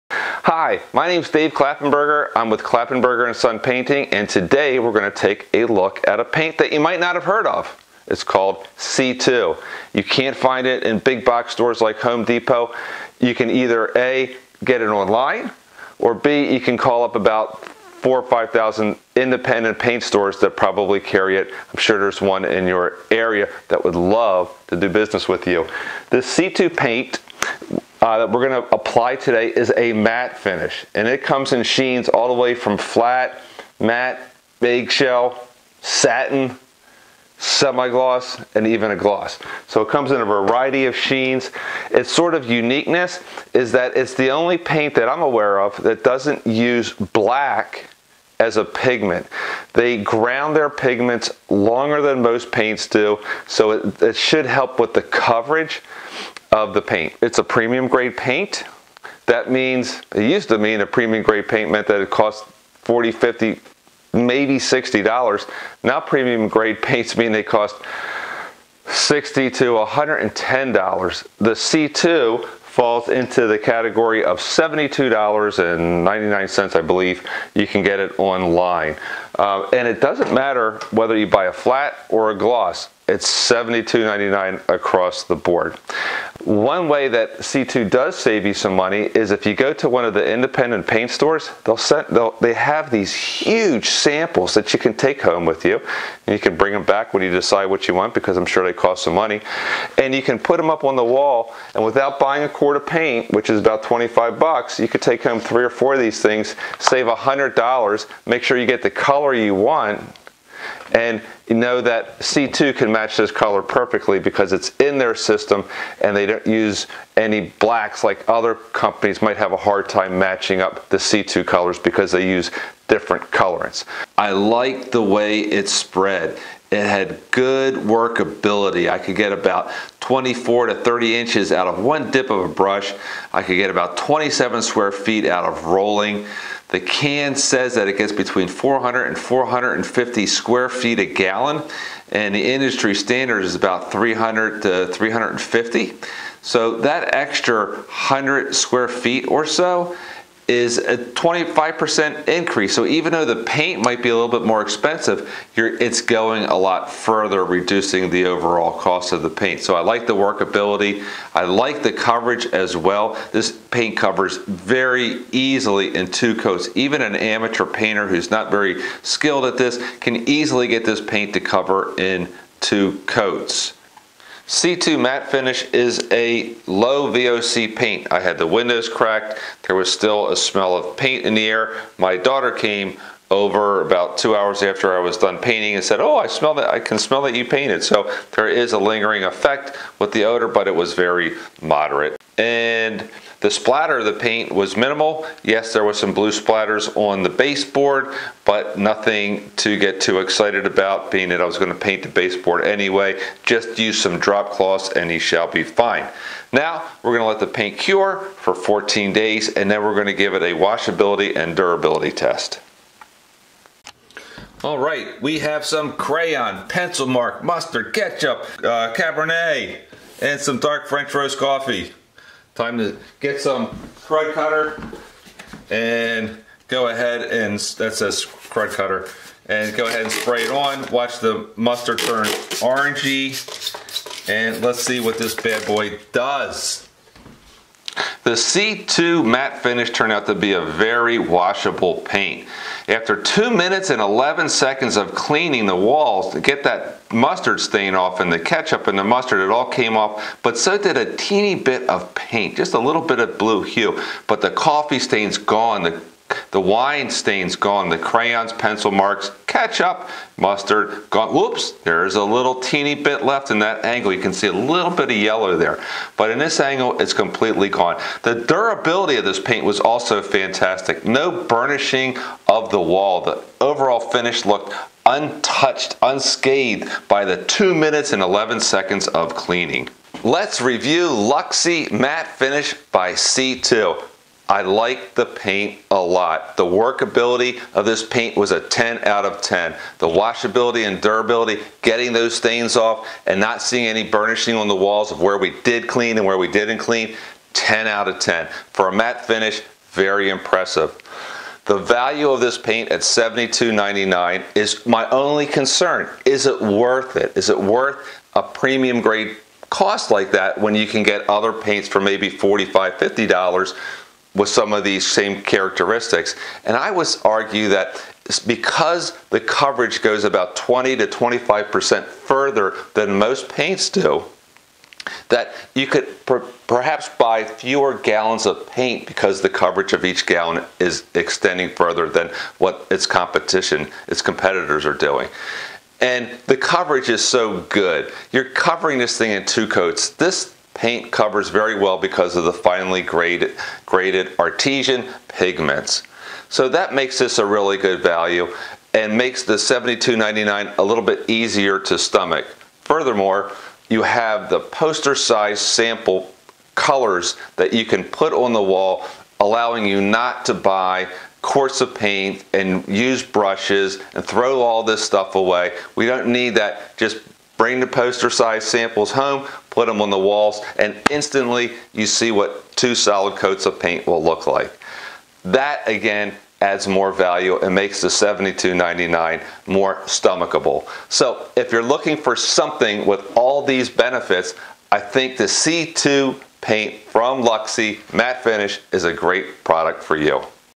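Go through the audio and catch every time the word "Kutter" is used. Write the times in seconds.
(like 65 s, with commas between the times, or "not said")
224 s, 228 s.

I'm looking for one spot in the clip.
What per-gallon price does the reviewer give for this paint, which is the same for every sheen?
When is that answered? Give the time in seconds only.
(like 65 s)
83 s.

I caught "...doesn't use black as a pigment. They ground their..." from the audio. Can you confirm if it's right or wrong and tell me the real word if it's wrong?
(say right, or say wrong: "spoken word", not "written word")
right.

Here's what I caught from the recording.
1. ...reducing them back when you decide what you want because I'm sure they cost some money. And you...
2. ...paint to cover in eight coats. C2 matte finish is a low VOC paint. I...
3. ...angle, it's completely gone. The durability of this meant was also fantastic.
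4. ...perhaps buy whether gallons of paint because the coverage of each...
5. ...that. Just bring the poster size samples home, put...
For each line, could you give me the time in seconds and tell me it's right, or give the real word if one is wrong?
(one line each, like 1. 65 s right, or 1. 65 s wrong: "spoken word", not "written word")
1. 96 s wrong: "bring", not "reducing"
2. 171 s wrong: "two", not "eight"
3. 266 s wrong: "paint", not "meant"
4. 326 s wrong: "fewer", not "whether"
5. 366 s right.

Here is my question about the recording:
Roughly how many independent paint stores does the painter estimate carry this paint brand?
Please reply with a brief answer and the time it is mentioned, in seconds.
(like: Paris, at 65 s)
4,000 or 5,000, at 17 s.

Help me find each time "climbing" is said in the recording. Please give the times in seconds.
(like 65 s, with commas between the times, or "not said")
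not said.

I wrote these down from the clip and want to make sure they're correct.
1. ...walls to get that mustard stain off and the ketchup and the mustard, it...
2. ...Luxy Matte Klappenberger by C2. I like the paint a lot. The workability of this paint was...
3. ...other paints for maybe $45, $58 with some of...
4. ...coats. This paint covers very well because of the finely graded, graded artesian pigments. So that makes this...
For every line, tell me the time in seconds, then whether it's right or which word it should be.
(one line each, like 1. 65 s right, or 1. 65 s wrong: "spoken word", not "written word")
1. 245 s right
2. 281 s wrong: "Finish", not "Klappenberger"
3. 311 s wrong: "50", not "58"
4. 339 s right.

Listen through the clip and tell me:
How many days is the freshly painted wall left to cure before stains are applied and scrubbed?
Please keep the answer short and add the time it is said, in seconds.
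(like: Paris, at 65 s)
14, at 208 s.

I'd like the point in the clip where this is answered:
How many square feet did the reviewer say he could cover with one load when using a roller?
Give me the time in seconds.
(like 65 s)
133 s.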